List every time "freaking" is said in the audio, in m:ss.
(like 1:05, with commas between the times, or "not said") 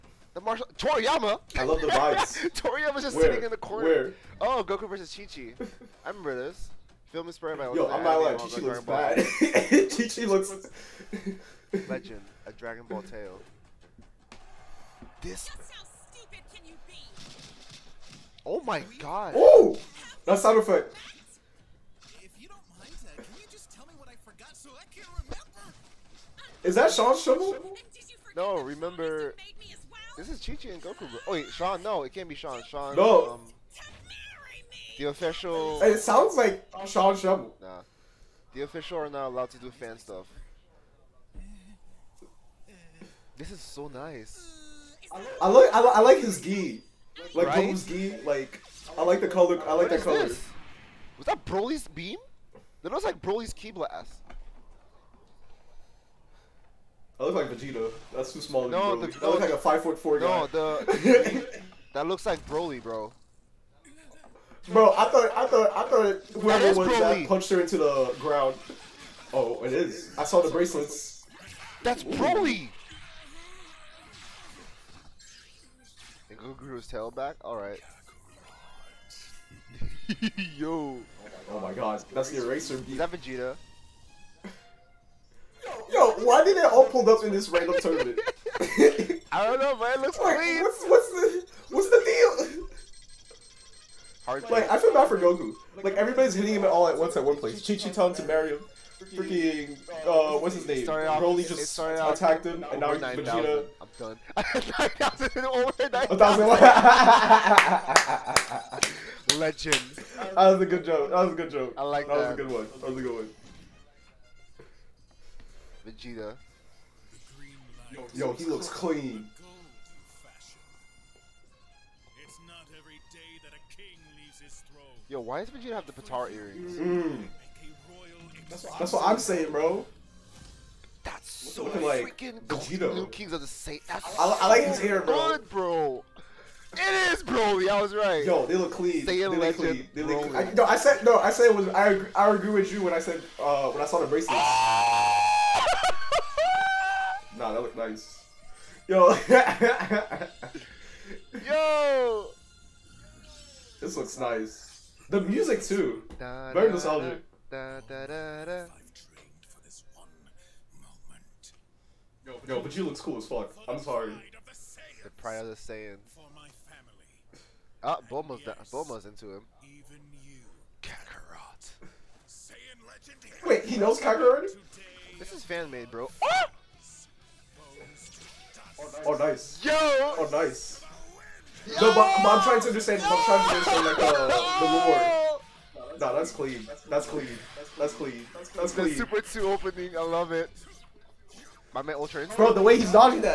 1:39, 2:12.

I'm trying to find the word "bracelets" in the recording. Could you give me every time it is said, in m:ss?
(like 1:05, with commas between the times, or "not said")
1:10, 2:24.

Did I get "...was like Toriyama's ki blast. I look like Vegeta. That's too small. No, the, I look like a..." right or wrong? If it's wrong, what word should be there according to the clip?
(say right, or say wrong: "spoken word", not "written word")
wrong: "Broly", not "Toriyama".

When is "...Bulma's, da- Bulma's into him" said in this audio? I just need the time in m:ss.
2:48.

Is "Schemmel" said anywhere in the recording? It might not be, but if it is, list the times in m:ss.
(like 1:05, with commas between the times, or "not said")
0:27, 0:37.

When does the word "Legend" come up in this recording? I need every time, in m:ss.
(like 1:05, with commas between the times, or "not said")
0:11, 1:49.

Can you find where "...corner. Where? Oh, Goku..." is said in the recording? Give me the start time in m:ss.
0:03.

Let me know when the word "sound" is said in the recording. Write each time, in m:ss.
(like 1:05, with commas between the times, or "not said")
0:20, 0:35.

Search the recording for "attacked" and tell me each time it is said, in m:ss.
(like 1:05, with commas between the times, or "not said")
1:41.